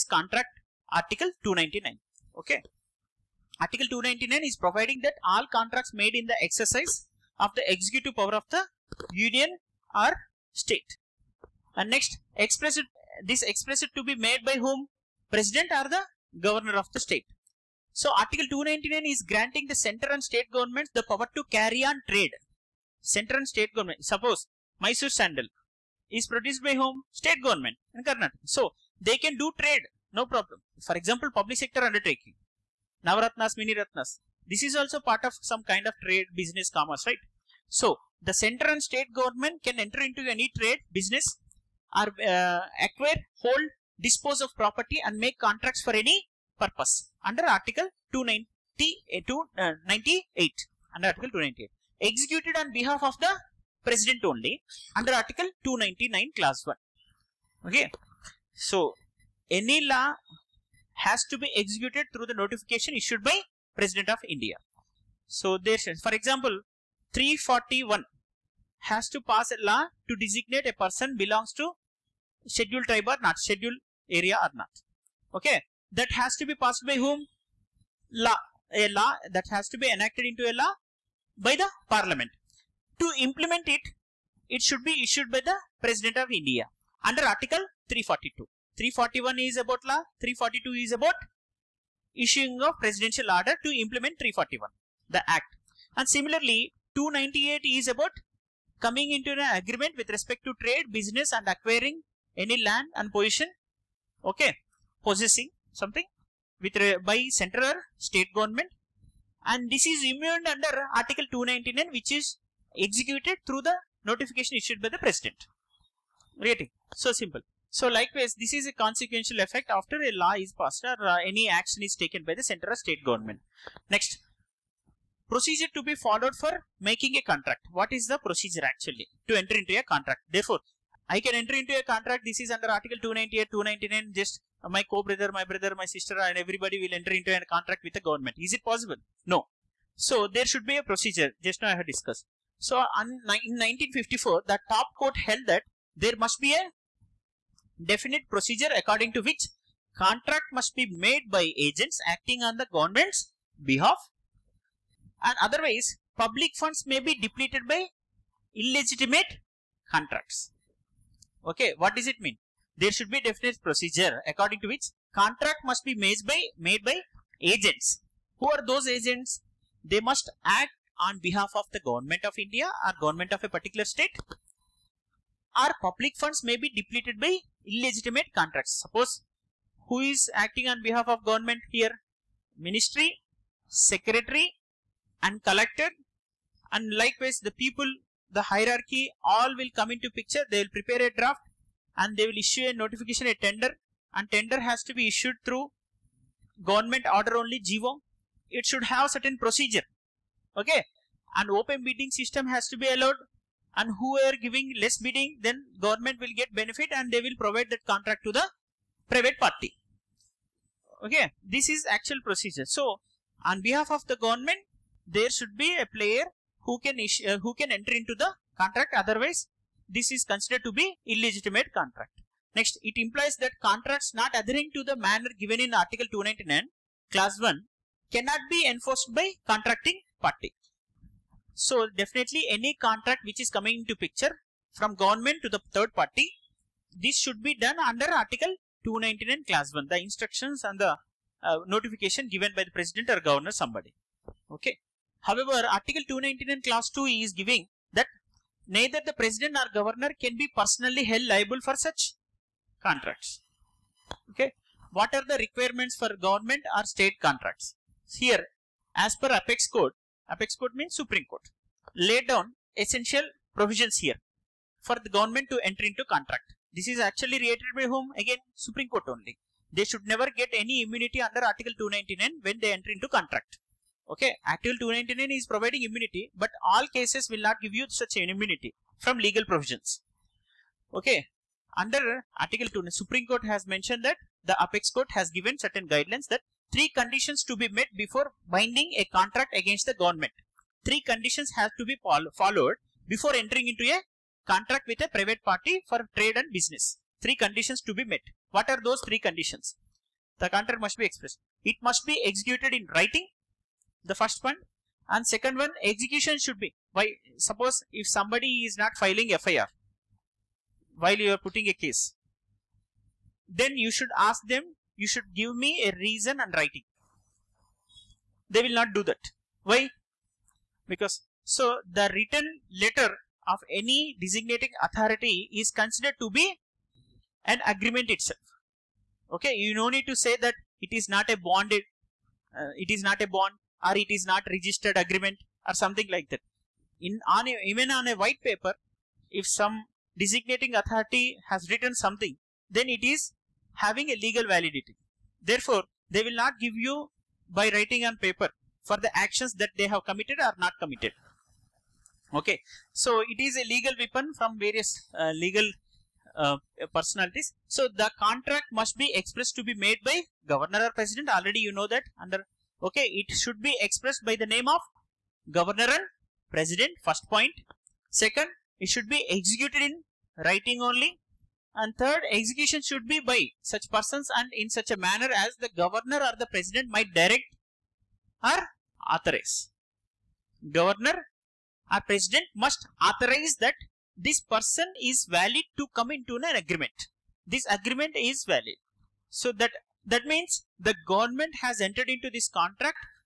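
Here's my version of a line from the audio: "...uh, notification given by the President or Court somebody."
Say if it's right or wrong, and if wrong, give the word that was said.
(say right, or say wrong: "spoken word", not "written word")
wrong: "Governor", not "Court".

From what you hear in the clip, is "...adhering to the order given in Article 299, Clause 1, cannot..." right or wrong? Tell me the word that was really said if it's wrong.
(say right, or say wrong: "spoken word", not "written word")
wrong: "manner", not "order".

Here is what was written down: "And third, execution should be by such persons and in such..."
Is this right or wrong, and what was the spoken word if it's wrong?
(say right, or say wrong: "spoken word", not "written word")
right.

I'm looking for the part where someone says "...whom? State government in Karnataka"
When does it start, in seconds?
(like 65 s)
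26 s.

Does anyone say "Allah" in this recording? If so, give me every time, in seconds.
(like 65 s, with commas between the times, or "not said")
not said.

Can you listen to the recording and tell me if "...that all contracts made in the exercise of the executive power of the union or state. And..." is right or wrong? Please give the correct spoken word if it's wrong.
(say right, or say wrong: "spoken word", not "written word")
right.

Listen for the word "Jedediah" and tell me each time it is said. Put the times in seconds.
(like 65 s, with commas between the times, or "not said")
not said.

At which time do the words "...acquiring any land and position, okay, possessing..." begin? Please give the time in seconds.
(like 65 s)
101 s.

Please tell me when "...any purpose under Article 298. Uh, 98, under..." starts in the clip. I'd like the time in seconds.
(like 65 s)
45 s.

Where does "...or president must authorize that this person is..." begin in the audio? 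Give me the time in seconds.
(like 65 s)
381 s.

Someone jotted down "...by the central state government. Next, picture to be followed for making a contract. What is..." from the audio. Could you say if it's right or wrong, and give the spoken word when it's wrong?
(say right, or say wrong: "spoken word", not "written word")
wrong: "procedure", not "picture".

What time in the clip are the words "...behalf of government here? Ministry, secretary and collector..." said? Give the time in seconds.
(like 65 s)
180 s.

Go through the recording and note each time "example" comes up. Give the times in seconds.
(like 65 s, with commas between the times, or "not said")
31 s, 66 s.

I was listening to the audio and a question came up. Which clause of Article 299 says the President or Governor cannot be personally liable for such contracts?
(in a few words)
Clause 2.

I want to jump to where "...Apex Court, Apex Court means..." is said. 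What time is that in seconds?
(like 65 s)
259 s.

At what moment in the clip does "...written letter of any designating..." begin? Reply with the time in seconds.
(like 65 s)
322 s.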